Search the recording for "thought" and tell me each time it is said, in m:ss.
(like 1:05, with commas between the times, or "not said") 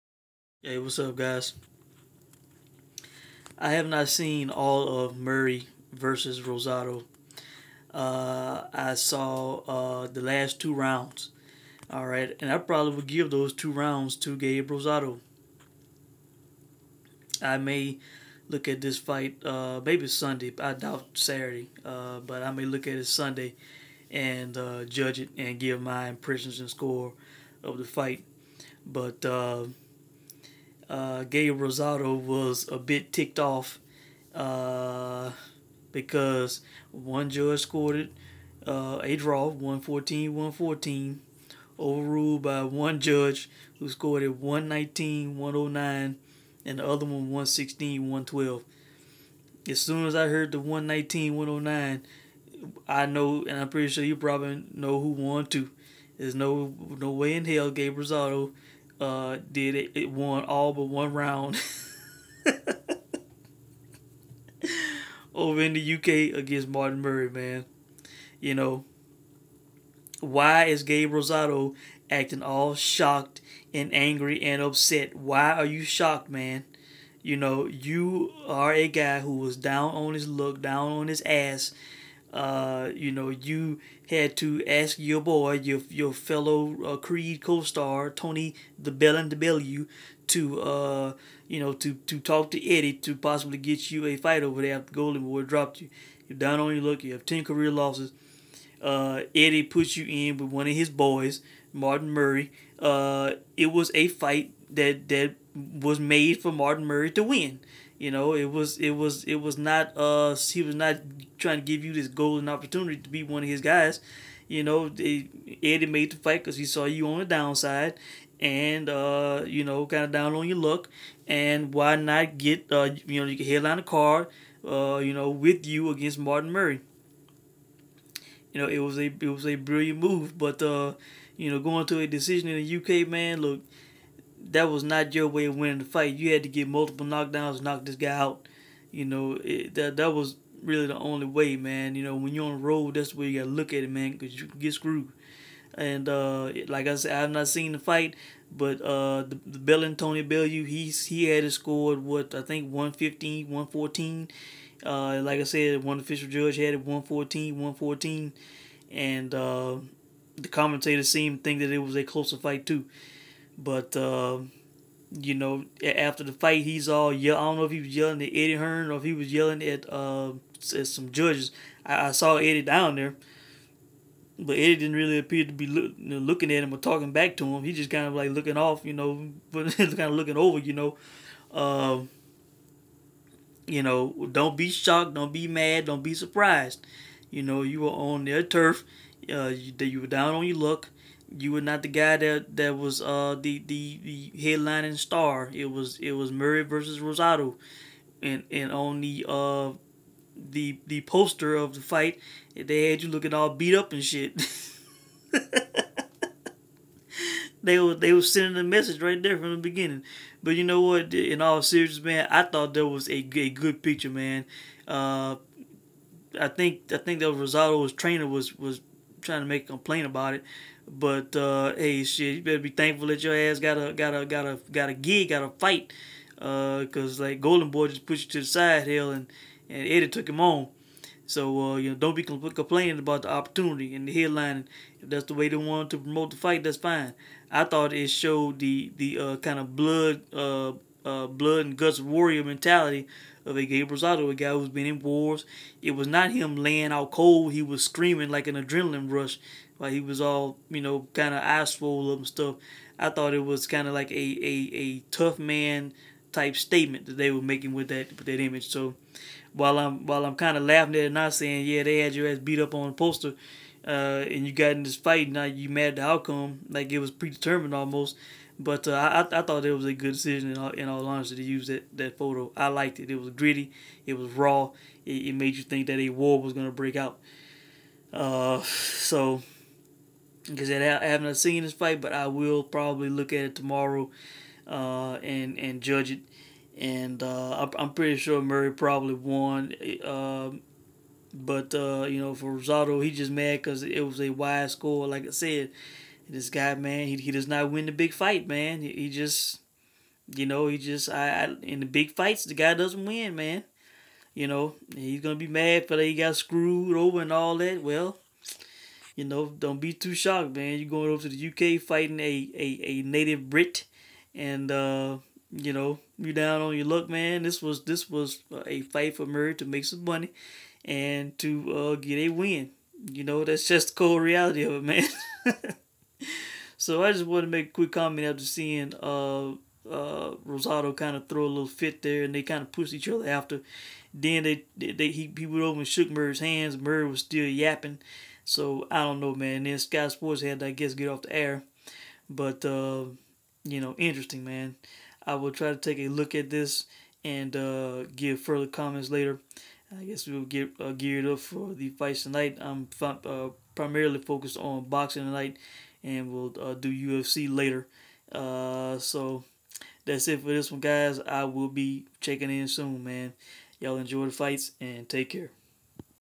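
3:32, 3:57, 4:13, 4:29.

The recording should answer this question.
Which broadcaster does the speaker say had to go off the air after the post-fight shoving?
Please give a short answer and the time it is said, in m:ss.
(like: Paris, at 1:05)
Sky Sports, at 5:39.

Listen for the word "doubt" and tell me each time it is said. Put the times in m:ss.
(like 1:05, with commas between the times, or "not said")
0:20.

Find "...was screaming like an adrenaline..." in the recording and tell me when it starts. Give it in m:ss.
4:07.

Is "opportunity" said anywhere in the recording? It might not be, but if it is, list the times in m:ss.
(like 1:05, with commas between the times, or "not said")
1:52, 3:53.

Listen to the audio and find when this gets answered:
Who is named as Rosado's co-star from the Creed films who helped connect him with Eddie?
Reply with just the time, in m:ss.
1:28.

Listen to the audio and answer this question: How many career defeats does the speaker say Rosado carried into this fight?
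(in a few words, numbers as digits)
10.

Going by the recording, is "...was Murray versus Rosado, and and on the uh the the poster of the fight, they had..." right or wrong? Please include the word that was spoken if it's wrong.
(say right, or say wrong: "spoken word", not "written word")
right.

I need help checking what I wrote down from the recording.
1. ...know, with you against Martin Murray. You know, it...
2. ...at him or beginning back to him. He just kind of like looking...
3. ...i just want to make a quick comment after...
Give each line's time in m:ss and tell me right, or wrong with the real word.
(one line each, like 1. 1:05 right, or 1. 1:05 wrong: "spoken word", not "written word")
1. 2:05 right
2. 2:56 wrong: "talking", not "beginning"
3. 5:27 right.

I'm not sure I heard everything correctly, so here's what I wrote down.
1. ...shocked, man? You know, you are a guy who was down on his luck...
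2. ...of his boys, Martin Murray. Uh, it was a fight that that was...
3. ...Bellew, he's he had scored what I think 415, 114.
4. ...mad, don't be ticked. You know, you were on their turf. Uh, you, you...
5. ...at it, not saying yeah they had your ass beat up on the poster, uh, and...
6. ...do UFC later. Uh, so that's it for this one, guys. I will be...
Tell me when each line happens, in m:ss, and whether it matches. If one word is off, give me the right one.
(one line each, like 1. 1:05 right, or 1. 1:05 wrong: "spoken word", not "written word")
1. 1:15 right
2. 1:40 right
3. 2:30 wrong: "115", not "415"
4. 3:05 wrong: "surprised", not "ticked"
5. 4:20 right
6. 5:56 right.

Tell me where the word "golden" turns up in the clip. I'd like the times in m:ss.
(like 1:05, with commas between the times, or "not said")
1:34, 1:52, 3:47.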